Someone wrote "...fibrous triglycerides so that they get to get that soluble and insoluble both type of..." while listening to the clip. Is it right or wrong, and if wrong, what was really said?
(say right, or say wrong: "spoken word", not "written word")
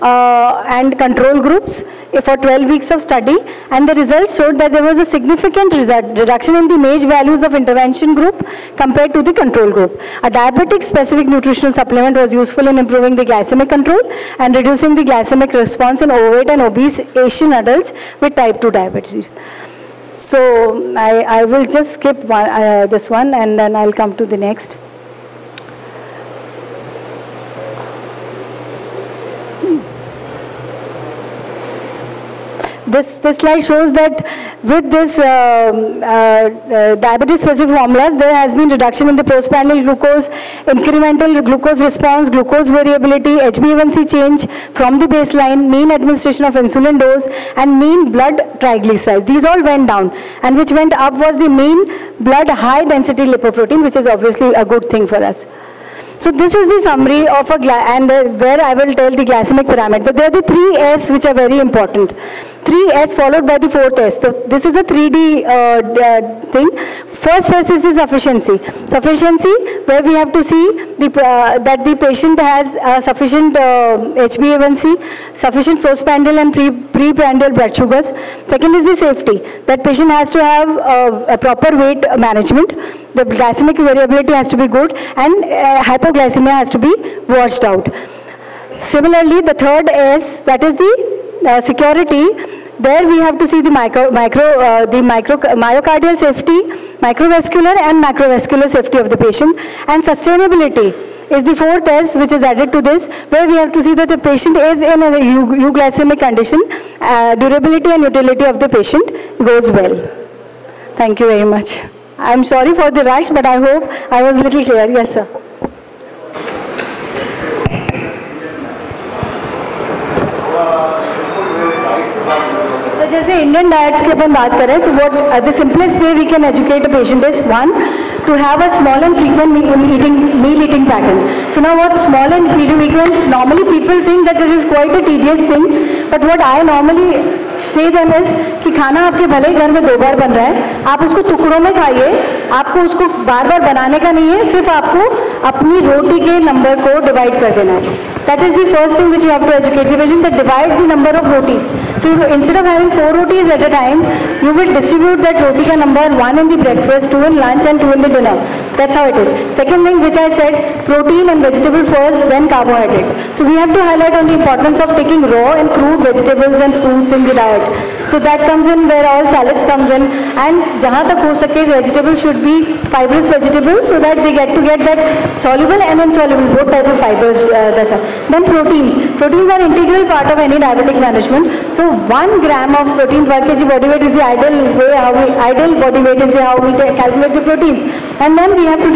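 wrong: "vegetables", not "triglycerides".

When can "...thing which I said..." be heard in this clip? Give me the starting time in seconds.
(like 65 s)
159 s.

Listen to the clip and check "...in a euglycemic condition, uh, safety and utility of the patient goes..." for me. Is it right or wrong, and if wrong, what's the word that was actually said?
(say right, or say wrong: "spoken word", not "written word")
wrong: "durability", not "safety".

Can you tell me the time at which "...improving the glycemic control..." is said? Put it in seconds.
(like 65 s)
12 s.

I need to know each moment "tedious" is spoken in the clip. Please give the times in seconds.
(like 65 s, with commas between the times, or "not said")
135 s.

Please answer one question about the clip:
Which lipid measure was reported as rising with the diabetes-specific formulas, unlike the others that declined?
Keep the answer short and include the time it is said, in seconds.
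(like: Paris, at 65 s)
high-density lipoprotein, at 52 s.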